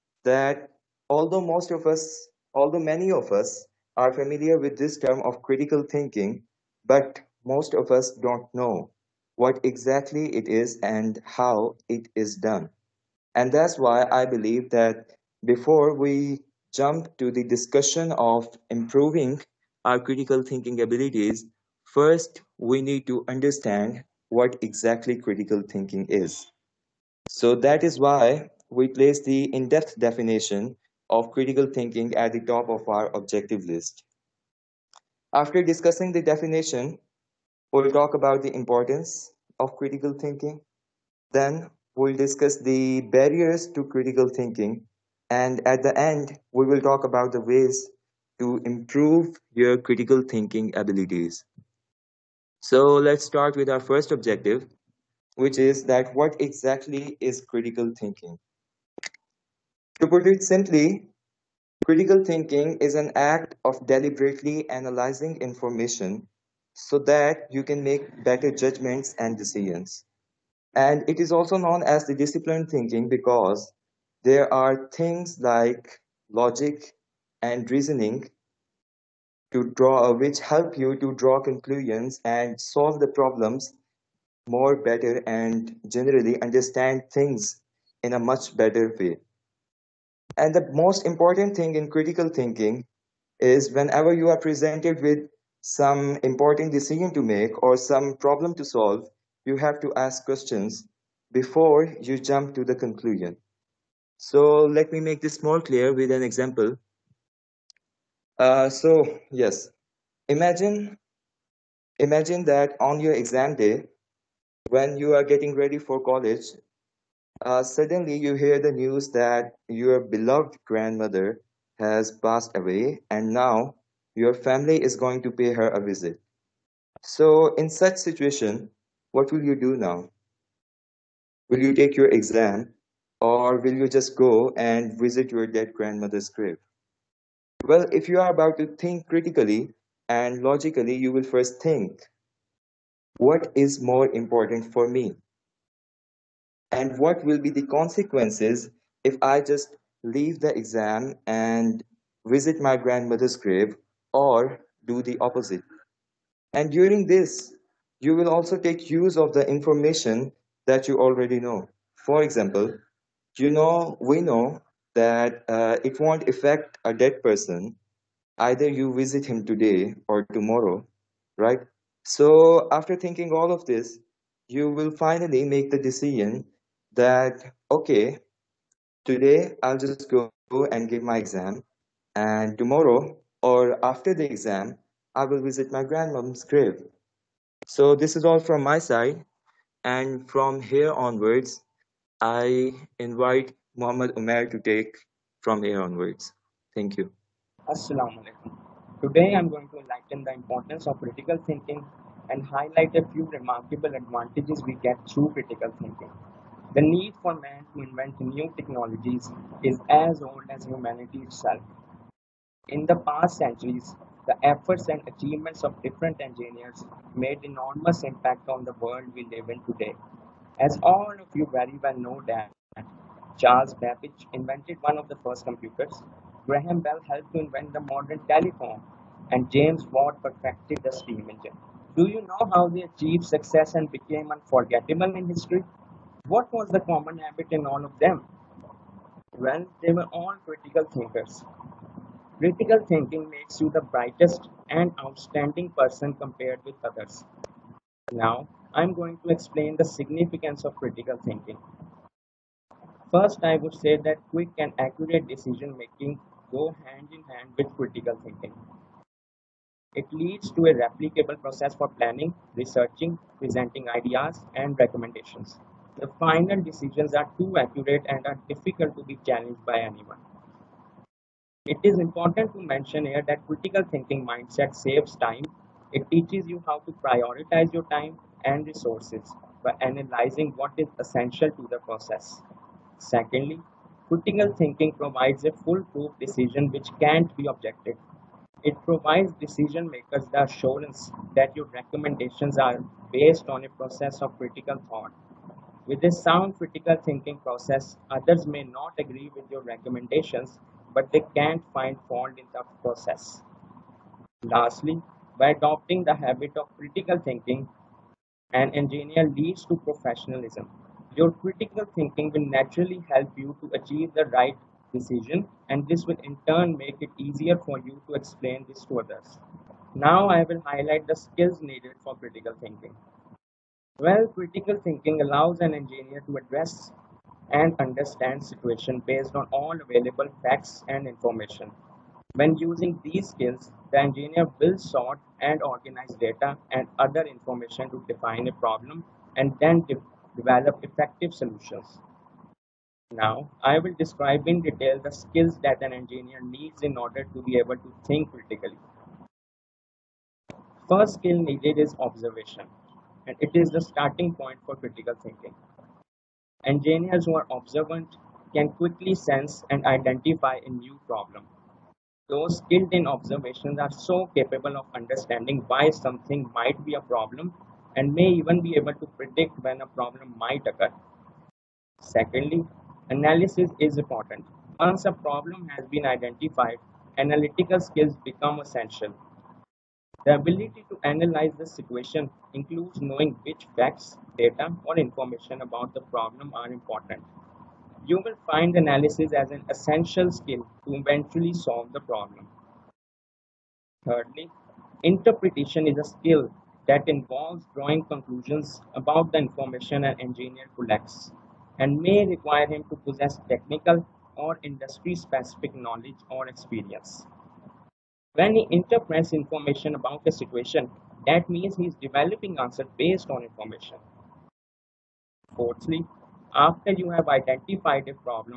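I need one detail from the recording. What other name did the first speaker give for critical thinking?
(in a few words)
disciplined thinking.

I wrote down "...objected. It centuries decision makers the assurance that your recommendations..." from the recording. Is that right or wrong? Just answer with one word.
wrong.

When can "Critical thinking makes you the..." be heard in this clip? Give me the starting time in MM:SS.
04:02.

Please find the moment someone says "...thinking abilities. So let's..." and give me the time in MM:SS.
00:50.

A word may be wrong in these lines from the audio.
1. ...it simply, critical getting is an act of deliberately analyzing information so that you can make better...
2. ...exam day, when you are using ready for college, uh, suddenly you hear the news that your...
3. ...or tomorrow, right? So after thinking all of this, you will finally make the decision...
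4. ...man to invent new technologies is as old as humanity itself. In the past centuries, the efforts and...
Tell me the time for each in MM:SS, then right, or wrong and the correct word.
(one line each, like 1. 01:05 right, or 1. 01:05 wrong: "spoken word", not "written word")
1. 01:00 wrong: "thinking", not "getting"
2. 01:53 wrong: "getting", not "using"
3. 02:50 right
4. 03:27 right.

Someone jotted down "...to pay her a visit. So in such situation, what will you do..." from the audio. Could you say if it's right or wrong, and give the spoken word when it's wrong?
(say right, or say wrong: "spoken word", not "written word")
right.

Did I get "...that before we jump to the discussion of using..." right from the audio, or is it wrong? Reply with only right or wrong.
wrong.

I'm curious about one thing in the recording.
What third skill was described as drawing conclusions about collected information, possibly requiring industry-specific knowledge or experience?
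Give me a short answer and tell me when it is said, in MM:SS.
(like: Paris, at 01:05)
interpretation, at 06:35.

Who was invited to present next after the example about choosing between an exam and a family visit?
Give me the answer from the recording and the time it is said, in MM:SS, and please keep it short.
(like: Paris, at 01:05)
Muhammad Umar, at 03:13.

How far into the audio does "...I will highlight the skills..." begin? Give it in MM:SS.
05:20.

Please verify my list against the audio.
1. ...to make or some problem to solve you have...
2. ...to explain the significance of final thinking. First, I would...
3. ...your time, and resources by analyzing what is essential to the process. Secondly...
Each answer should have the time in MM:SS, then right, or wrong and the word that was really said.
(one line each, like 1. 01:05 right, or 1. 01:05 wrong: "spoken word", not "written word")
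1. 01:37 right
2. 04:09 wrong: "critical", not "final"
3. 04:37 right.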